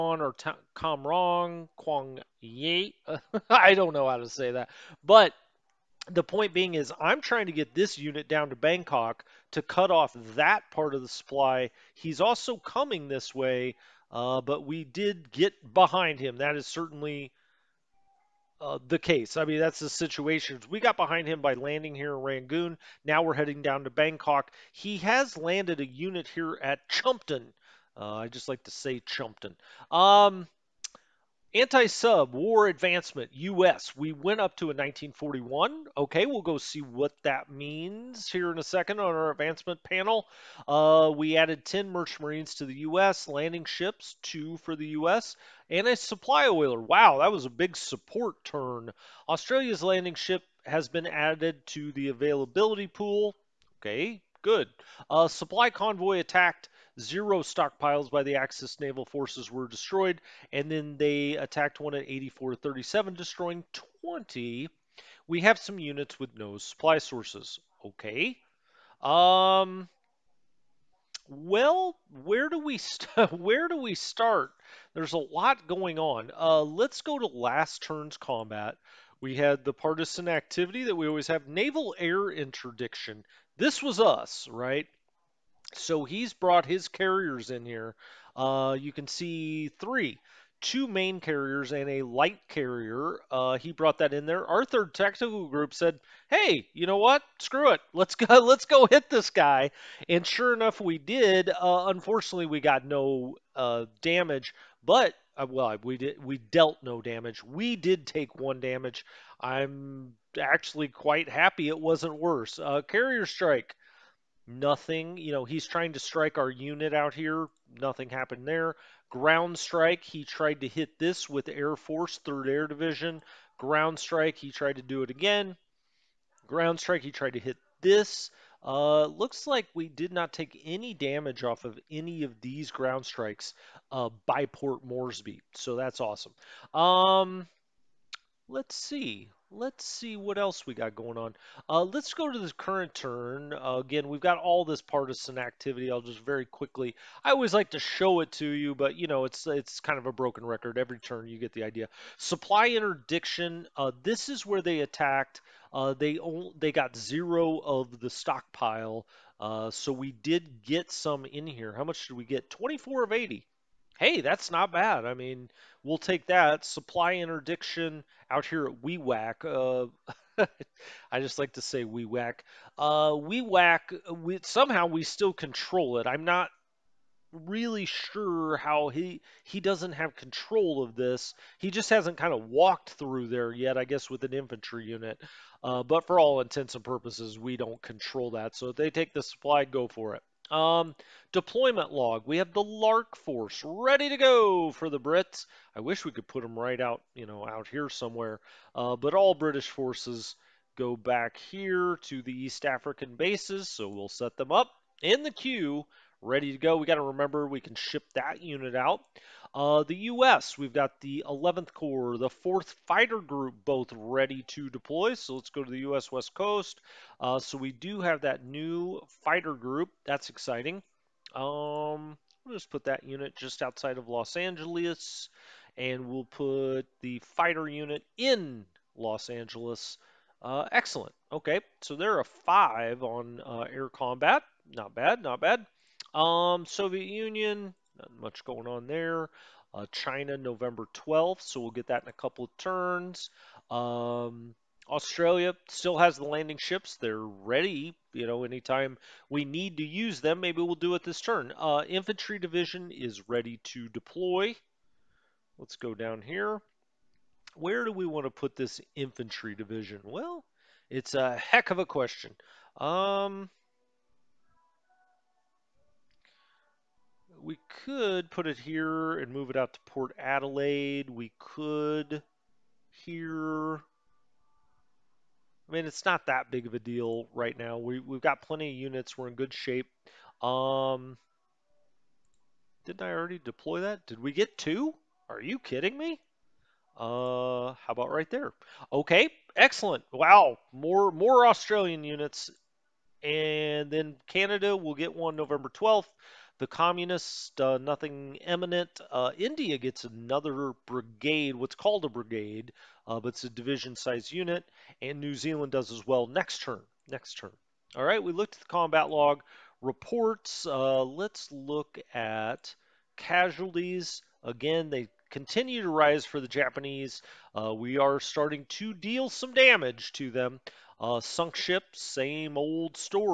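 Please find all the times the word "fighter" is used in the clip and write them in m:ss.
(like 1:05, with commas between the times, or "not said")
3:32, 3:39, 3:47.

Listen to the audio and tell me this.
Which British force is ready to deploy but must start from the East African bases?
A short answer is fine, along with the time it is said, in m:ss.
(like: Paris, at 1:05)
Lark Force, at 3:12.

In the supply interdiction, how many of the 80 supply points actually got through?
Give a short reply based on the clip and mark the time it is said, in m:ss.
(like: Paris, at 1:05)
24, at 2:42.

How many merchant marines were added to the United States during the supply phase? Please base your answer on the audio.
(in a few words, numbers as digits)
10.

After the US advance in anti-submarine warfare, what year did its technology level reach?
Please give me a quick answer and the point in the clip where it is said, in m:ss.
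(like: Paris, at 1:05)
1941, at 0:34.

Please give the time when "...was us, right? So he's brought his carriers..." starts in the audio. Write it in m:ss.
1:23.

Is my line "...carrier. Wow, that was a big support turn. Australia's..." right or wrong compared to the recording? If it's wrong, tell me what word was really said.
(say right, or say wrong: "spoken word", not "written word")
wrong: "oiler", not "carrier".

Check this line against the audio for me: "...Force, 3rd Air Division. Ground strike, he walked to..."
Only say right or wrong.
wrong.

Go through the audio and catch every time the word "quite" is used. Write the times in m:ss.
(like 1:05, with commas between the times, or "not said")
1:50.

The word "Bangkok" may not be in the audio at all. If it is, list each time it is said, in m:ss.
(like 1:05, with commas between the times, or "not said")
0:08, 0:23.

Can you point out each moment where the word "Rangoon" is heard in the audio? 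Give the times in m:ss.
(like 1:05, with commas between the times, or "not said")
0:22.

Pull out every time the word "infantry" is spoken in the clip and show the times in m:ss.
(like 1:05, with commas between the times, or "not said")
3:04, 4:11, 4:18.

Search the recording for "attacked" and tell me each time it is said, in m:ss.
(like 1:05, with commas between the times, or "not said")
0:56, 1:01, 2:34.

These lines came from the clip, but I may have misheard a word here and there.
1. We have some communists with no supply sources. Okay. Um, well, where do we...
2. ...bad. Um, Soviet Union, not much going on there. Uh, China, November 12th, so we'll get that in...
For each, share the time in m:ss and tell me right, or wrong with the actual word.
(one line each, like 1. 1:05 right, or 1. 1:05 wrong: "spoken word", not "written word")
1. 1:05 wrong: "units", not "communists"
2. 3:55 right.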